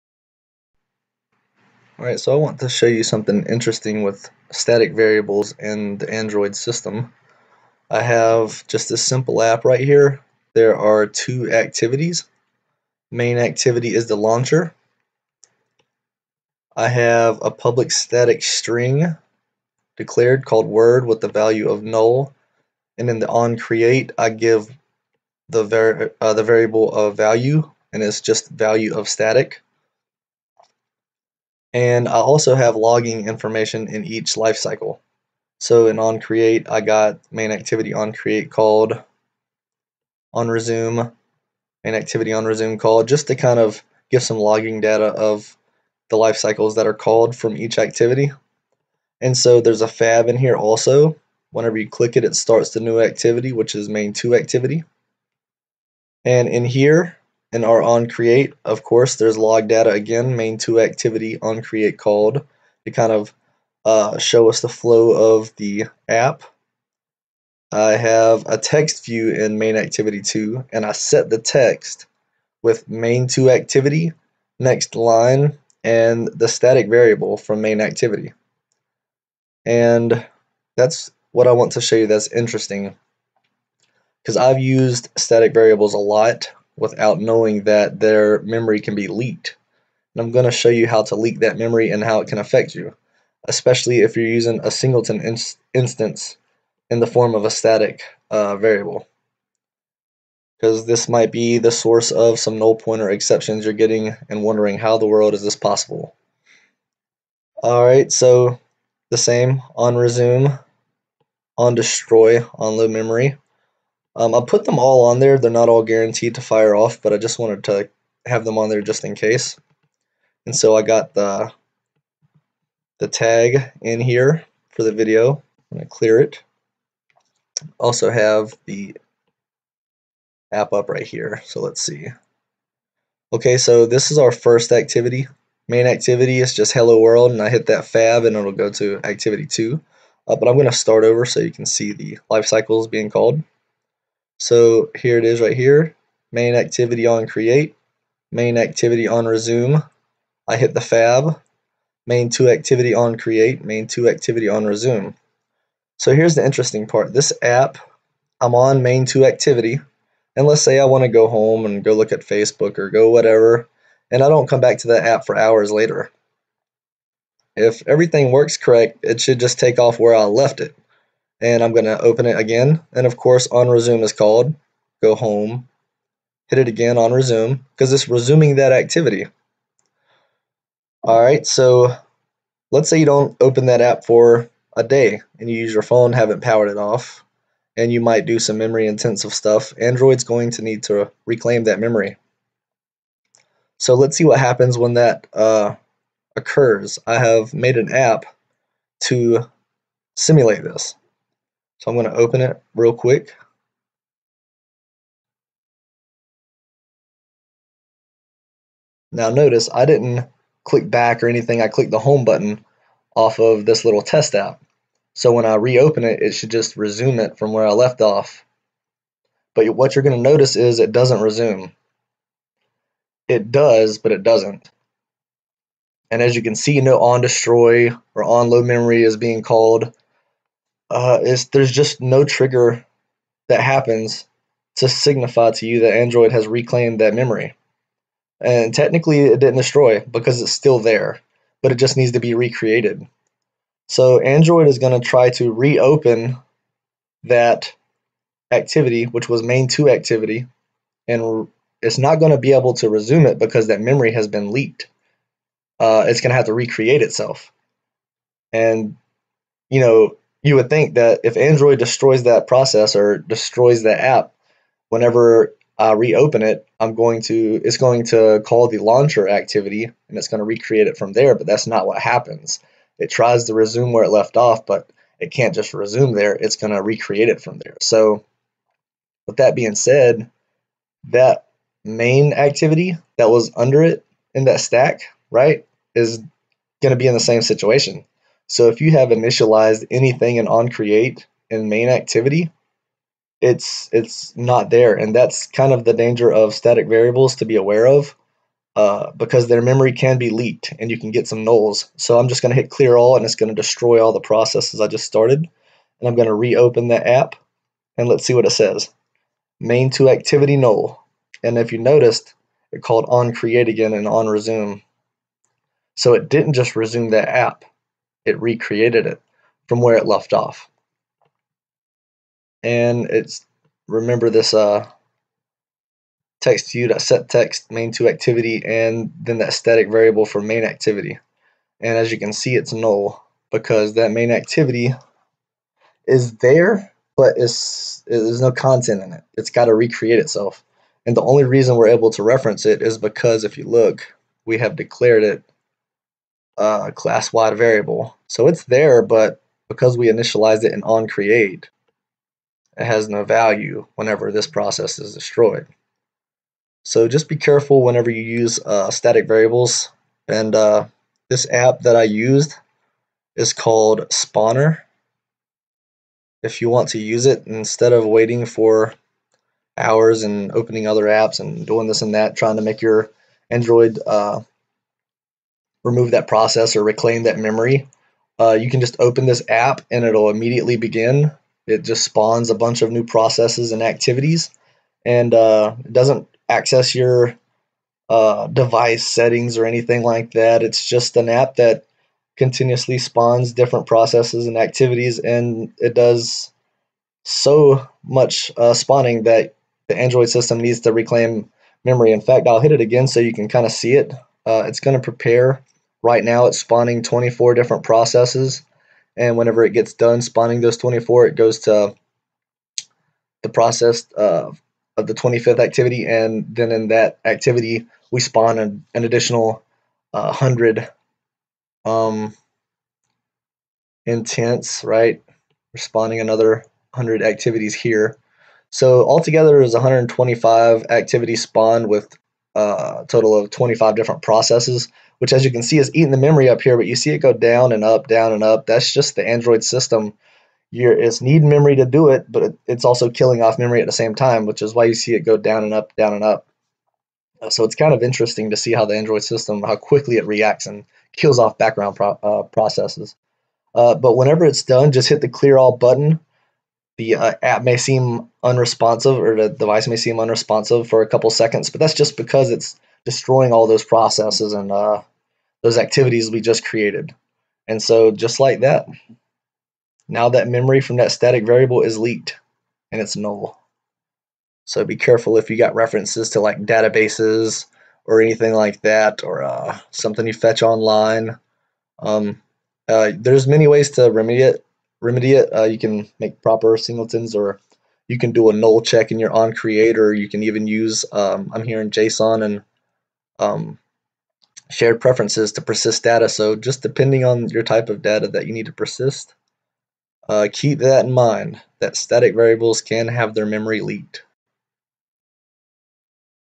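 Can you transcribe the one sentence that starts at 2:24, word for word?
So here it is right here, main activity on create, main activity on resume.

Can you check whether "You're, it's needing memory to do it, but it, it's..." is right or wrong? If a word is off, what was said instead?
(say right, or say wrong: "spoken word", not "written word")
right.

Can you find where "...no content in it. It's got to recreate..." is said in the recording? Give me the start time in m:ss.
5:38.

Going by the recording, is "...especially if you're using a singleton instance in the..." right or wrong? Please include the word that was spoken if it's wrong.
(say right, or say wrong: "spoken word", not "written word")
right.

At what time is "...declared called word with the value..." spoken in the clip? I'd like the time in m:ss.
0:19.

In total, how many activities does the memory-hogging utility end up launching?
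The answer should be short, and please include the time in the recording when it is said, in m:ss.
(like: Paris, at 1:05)
125, at 7:09.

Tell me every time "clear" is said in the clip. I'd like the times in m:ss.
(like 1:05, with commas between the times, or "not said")
2:05, 5:02, 7:35.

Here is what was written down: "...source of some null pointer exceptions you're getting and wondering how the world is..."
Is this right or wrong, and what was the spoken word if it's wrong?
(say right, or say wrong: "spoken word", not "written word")
right.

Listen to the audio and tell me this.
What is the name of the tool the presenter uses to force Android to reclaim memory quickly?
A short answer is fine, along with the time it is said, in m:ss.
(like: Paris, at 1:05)
Spawner, at 6:04.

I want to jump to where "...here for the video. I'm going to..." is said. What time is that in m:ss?
2:04.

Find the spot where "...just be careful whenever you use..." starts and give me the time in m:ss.
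5:57.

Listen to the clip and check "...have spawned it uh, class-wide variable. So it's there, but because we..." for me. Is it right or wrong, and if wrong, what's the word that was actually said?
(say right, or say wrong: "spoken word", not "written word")
wrong: "declared", not "spawned".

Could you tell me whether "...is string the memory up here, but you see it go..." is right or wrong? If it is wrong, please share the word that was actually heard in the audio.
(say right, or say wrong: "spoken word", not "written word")
wrong: "eating", not "string".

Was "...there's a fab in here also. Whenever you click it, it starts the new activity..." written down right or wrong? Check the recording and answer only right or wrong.
right.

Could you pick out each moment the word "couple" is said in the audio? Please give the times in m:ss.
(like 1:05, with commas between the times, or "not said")
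7:41.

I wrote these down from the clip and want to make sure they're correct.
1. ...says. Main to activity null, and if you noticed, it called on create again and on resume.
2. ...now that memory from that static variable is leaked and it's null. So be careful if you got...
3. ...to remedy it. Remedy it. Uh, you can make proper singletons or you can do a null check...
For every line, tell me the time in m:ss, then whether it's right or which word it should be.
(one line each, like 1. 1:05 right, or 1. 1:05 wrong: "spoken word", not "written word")
1. 5:08 right
2. 7:50 right
3. 8:03 right.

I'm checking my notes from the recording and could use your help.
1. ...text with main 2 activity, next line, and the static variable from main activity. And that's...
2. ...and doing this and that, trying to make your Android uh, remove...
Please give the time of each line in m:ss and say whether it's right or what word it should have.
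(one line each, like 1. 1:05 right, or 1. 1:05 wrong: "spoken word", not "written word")
1. 1:11 right
2. 6:11 right.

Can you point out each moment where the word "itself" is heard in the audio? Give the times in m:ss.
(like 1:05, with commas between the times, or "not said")
4:17, 5:40.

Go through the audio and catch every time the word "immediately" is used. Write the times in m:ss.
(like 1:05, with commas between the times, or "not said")
6:20.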